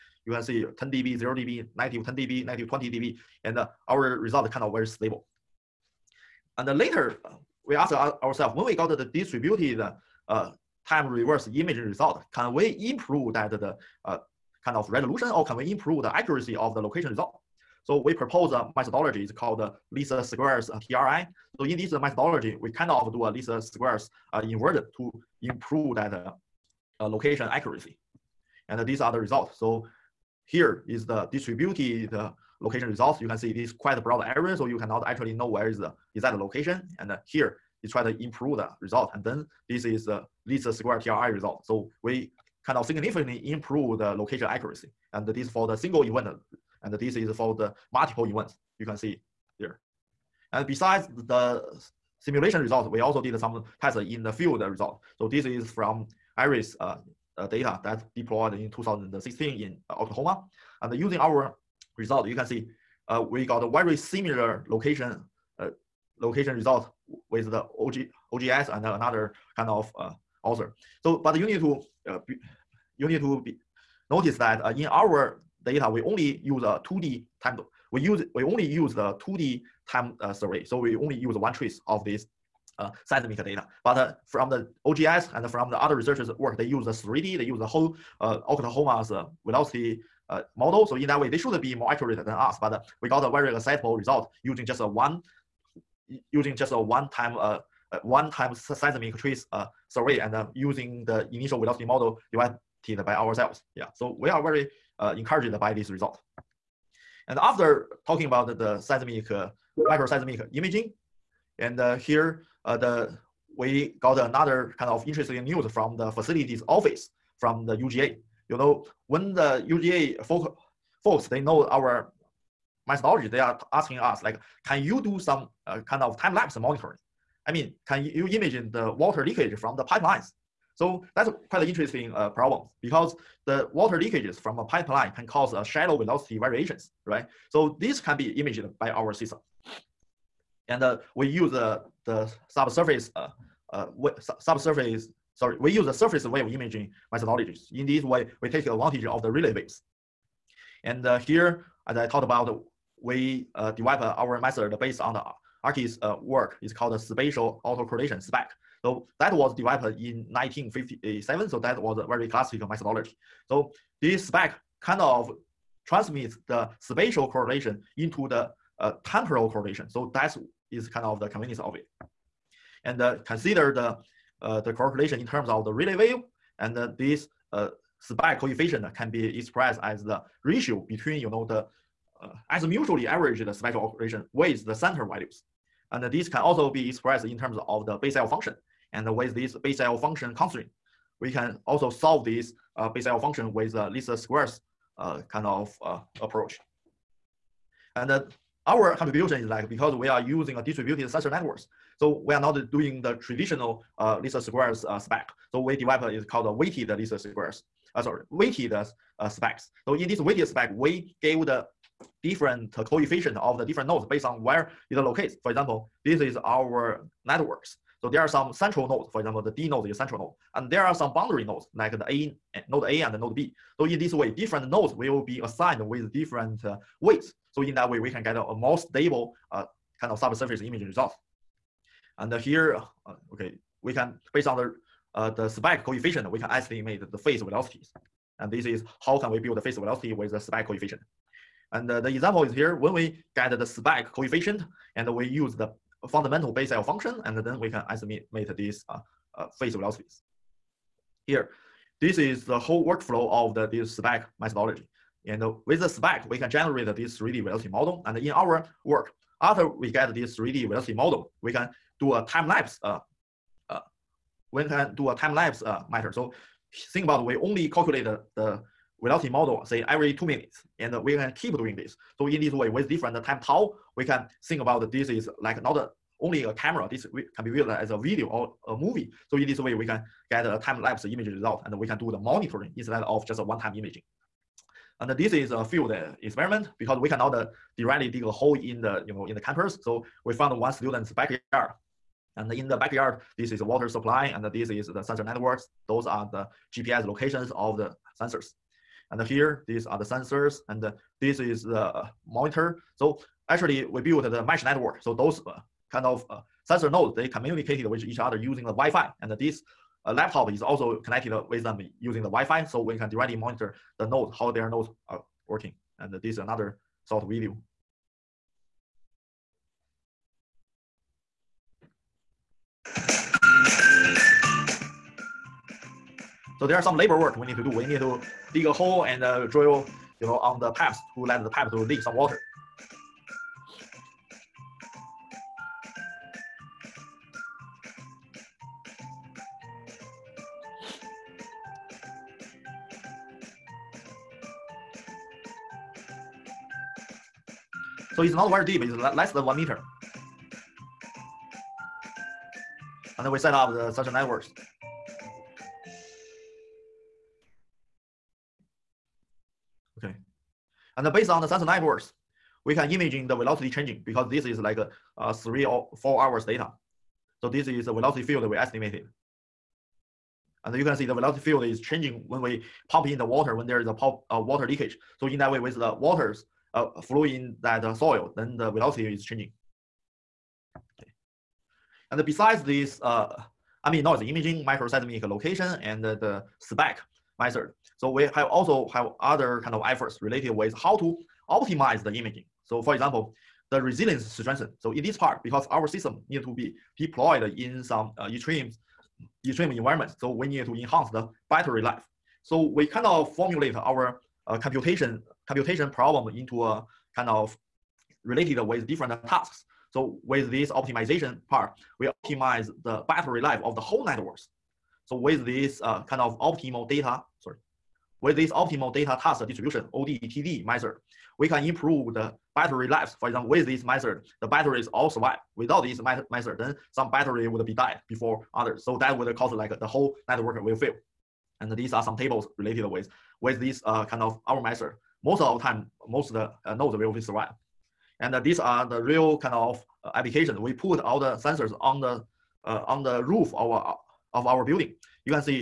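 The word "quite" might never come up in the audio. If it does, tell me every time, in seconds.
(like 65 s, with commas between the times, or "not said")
33 s, 131 s.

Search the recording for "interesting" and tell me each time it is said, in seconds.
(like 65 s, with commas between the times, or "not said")
115 s, 131 s.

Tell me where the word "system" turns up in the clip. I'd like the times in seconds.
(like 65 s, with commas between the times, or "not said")
139 s, 395 s.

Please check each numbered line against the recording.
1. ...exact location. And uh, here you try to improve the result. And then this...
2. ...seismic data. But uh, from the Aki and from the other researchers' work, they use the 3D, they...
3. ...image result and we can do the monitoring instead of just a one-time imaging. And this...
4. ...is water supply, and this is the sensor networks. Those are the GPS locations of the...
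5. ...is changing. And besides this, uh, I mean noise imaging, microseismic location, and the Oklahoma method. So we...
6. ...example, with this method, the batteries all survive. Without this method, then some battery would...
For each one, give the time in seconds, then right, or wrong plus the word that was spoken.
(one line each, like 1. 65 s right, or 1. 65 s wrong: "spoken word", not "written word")
1. 36 s right
2. 83 s wrong: "OGS", not "Aki"
3. 281 s right
4. 293 s right
5. 379 s wrong: "SPAC", not "Oklahoma"
6. 423 s right.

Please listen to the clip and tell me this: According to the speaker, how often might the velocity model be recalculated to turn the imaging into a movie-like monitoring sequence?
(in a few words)
every two minutes.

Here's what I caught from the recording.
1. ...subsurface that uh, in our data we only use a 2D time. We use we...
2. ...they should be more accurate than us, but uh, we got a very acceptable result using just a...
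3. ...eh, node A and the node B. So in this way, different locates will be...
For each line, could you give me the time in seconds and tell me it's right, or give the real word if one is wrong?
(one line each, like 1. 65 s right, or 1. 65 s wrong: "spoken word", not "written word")
1. 74 s wrong: "notice", not "subsurface"
2. 91 s right
3. 222 s wrong: "nodes", not "locates".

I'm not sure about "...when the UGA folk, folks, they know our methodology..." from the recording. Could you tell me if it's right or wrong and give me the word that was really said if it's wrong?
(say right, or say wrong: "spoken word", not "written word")
right.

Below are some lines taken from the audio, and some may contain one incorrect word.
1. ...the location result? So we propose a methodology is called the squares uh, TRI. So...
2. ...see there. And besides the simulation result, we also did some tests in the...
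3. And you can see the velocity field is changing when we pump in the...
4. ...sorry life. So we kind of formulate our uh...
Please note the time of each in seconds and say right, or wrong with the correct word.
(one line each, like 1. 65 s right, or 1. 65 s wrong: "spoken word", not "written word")
1. 16 s right
2. 48 s right
3. 370 s right
4. 401 s wrong: "battery", not "sorry".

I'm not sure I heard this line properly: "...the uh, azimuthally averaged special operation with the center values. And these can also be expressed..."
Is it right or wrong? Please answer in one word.
right.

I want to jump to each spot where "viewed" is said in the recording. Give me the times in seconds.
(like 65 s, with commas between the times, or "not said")
277 s.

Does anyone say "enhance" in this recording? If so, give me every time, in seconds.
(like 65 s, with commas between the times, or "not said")
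400 s.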